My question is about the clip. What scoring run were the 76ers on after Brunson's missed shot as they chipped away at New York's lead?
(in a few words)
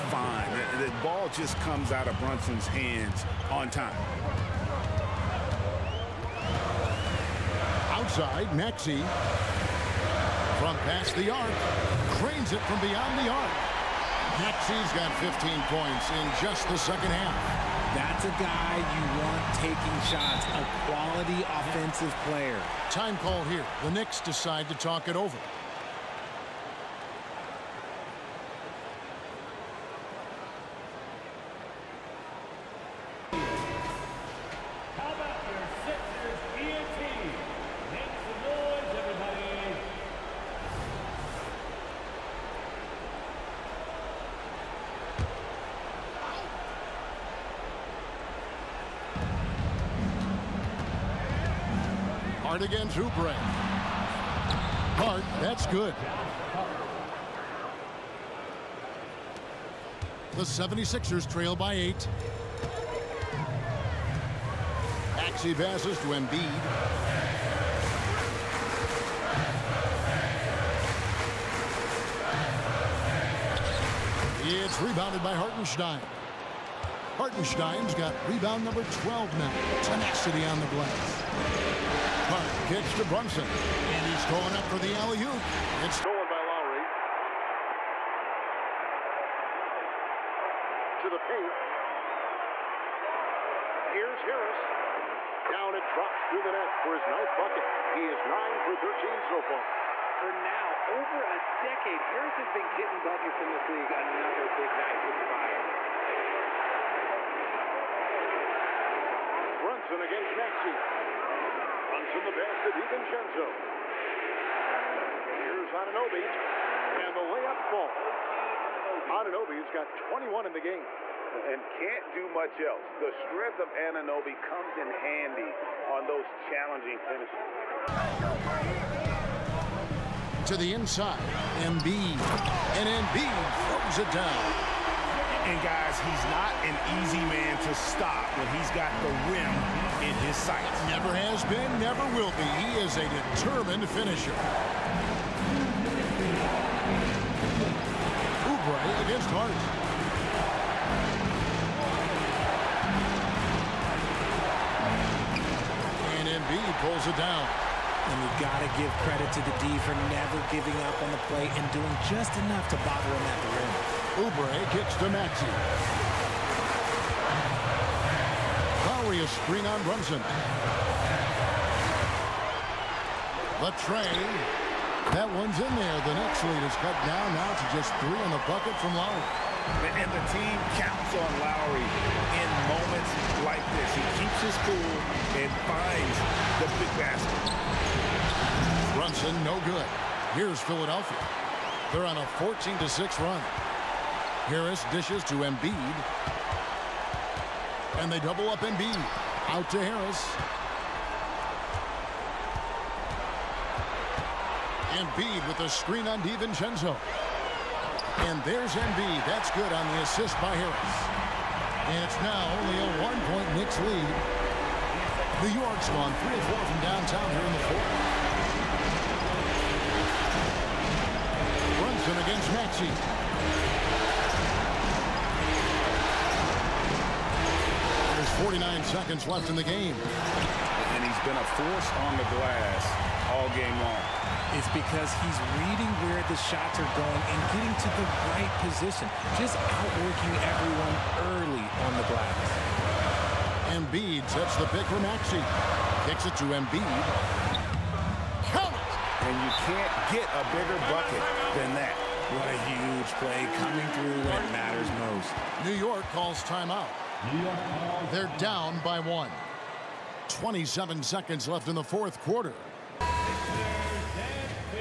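14-6.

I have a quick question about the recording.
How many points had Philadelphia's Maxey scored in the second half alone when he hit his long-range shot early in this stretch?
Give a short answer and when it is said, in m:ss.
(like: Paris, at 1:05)
15, at 0:15.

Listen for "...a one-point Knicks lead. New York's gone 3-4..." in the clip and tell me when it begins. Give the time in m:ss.
3:32.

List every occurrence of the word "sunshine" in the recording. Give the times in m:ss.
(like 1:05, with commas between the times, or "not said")
not said.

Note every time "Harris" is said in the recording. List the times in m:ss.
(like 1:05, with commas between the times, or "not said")
1:34, 1:42, 3:14, 3:19, 3:30.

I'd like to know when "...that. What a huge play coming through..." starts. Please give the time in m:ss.
4:11.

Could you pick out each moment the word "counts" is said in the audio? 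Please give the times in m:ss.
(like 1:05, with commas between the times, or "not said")
3:00, 4:08.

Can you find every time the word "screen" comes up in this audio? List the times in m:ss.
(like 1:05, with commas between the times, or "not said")
2:49, 3:25.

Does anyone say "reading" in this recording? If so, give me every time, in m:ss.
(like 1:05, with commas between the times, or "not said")
3:55.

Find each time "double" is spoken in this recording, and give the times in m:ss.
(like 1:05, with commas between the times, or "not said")
3:18.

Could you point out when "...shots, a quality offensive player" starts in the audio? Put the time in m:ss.
0:20.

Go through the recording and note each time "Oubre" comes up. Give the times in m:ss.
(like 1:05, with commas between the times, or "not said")
0:52, 2:28, 2:44.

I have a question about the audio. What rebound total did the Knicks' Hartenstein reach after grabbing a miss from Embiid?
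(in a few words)
12.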